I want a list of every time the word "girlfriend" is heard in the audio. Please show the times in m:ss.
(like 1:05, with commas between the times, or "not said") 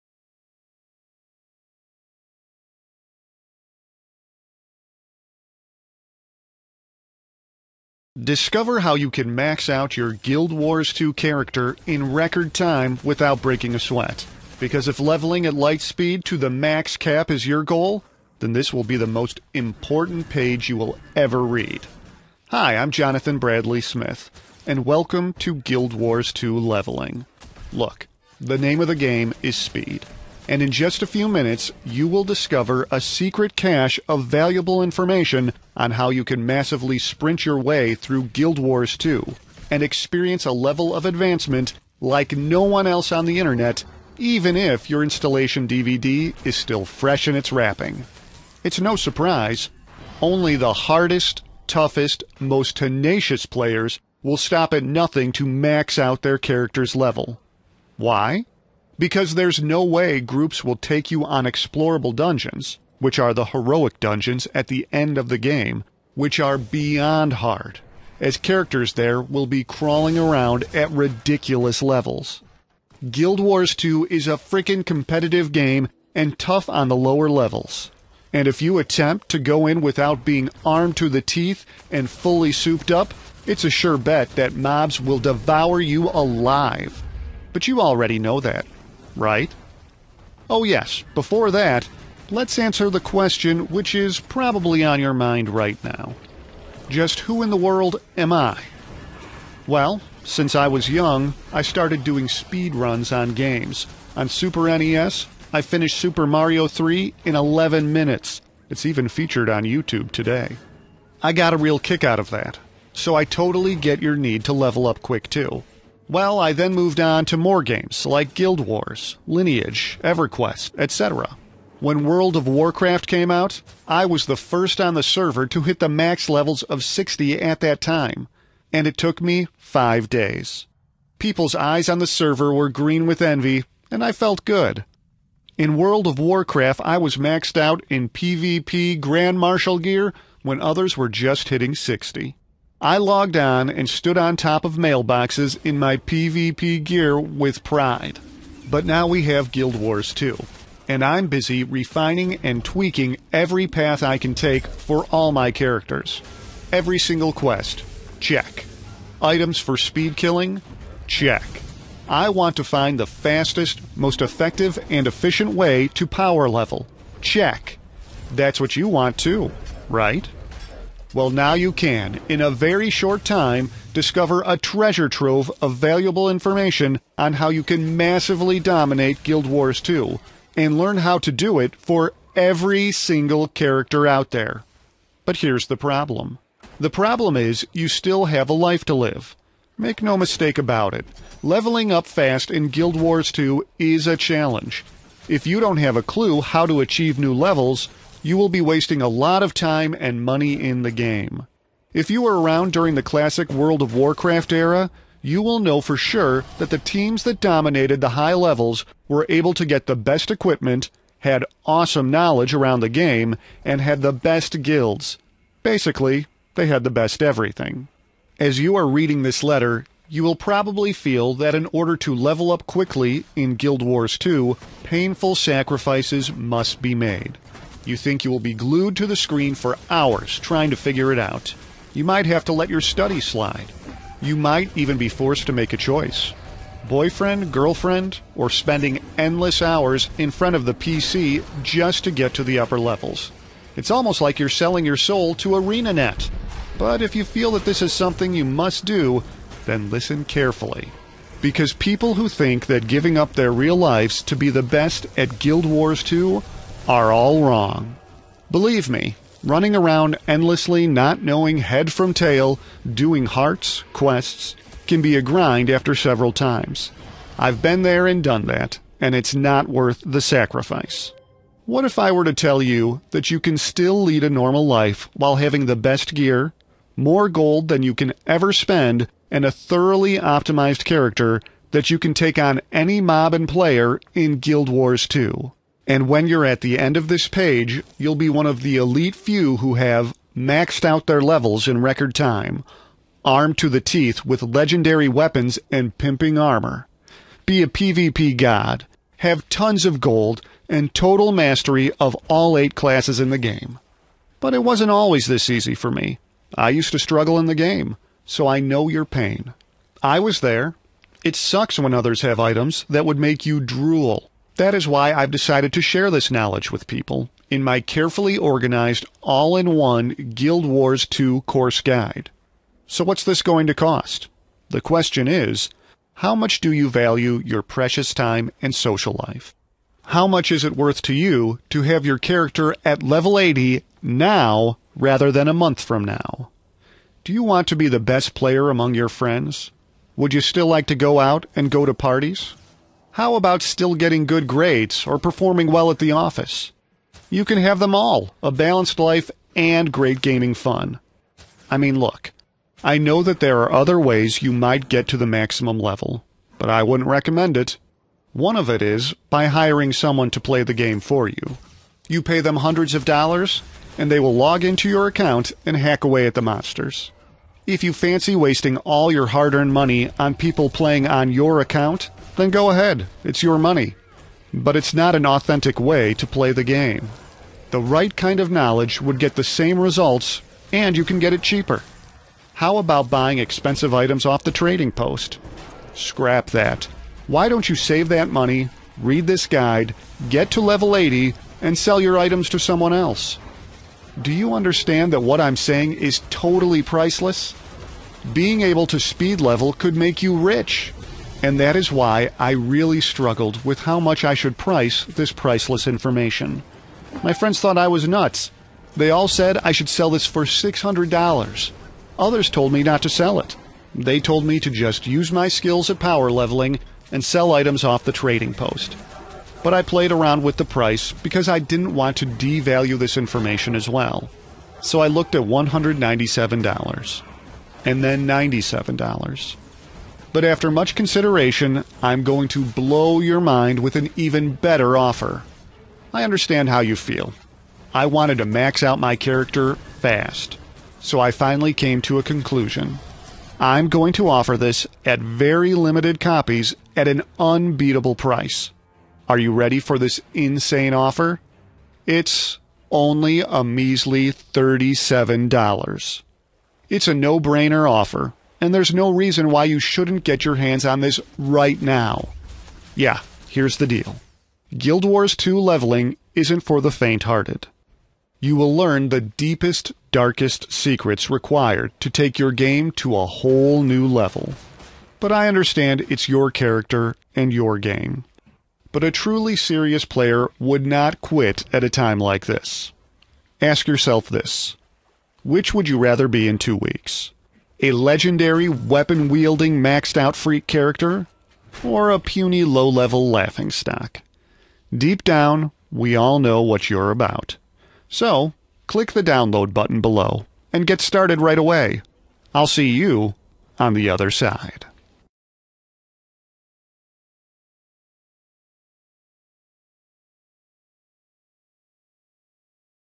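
3:57.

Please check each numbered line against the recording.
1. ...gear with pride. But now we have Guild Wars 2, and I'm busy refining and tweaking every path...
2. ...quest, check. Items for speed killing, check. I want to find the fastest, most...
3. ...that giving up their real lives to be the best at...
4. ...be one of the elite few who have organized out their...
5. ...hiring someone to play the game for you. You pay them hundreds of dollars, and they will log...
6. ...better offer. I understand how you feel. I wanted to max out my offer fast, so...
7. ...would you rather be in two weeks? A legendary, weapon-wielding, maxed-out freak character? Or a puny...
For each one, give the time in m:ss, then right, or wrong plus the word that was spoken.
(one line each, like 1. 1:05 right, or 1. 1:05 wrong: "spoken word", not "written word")
1. 2:26 right
2. 2:37 right
3. 4:12 right
4. 4:48 wrong: "maxed", not "organized"
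5. 5:59 right
6. 7:14 wrong: "character", not "offer"
7. 8:05 right.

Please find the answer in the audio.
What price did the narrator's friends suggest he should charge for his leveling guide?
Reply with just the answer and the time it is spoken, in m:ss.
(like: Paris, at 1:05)
$600, at 6:50.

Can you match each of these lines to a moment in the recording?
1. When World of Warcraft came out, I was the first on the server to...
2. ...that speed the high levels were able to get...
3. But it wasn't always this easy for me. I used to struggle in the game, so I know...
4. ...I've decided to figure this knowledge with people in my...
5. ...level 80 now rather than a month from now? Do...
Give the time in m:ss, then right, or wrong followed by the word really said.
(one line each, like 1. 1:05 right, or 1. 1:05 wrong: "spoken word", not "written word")
1. 2:01 right
2. 3:27 wrong: "dominated", not "speed"
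3. 5:04 right
4. 5:15 wrong: "share", not "figure"
5. 5:33 right.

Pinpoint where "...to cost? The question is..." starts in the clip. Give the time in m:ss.
5:23.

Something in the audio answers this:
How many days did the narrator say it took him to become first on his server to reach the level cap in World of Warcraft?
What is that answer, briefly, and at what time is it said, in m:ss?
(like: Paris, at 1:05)
5, at 2:09.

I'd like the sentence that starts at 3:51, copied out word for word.
You might have to let your study slide.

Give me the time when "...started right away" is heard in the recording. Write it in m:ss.
8:21.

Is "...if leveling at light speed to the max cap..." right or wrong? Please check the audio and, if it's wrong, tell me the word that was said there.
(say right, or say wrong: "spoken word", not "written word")
right.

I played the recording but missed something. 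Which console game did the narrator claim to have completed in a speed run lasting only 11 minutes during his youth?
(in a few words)
Super Mario 3.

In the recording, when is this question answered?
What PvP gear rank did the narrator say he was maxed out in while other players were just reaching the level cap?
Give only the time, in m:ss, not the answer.
2:18.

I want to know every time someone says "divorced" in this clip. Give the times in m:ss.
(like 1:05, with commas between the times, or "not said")
not said.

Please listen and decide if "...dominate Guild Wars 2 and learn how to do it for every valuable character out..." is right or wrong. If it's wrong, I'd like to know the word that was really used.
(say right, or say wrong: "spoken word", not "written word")
wrong: "single", not "valuable".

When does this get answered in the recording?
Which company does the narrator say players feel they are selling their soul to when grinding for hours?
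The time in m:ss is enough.
4:05.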